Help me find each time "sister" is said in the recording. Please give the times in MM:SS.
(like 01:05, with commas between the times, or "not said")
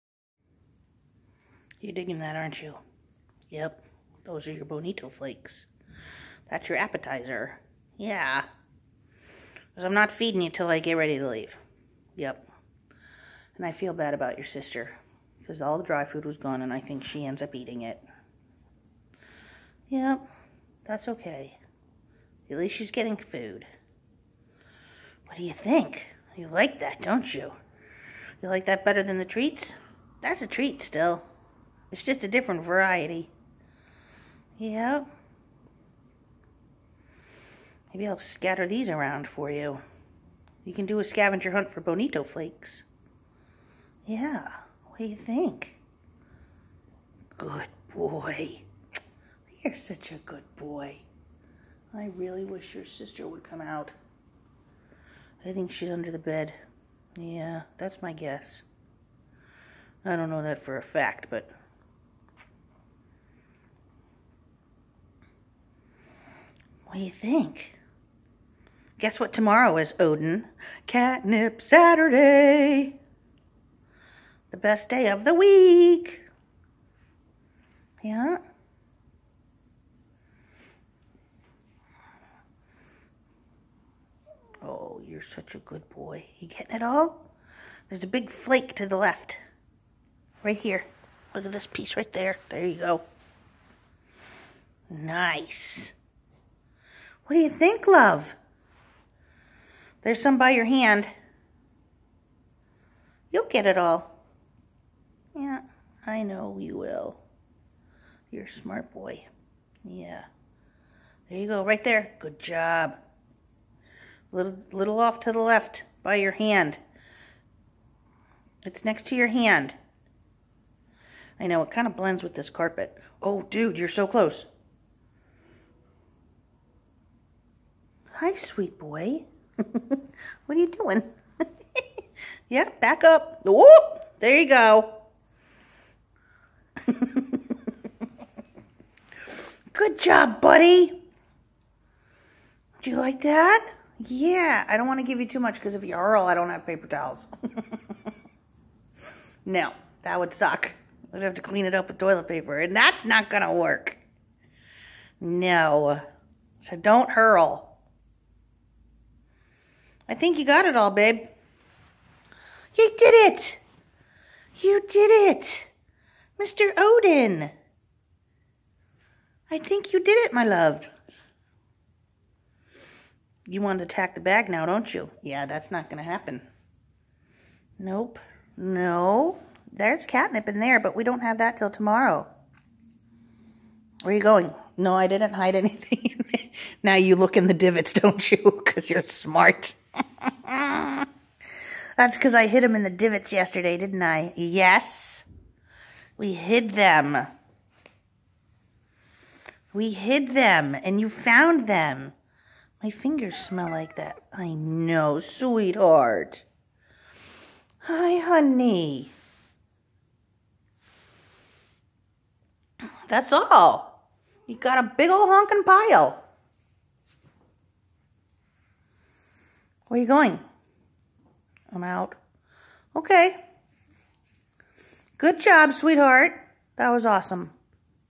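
00:14, 00:52.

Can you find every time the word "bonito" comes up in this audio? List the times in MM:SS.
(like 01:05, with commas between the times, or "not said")
00:04, 00:41.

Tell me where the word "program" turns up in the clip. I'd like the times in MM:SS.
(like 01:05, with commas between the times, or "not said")
not said.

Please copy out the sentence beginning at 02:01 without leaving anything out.
I know, it kind of blends with this carpet.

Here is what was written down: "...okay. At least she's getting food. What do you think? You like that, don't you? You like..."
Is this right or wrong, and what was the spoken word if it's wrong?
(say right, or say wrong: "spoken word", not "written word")
right.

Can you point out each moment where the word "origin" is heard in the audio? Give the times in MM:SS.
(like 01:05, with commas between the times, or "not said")
not said.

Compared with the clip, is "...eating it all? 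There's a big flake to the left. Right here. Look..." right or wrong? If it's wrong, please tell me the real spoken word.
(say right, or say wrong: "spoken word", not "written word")
wrong: "getting", not "eating".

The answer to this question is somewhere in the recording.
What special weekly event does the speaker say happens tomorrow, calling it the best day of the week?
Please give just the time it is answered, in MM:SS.
01:10.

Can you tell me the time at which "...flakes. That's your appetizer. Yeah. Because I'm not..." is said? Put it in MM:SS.
00:05.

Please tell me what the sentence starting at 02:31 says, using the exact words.
We'd have to clean it up with toilet paper, and that's not going to work.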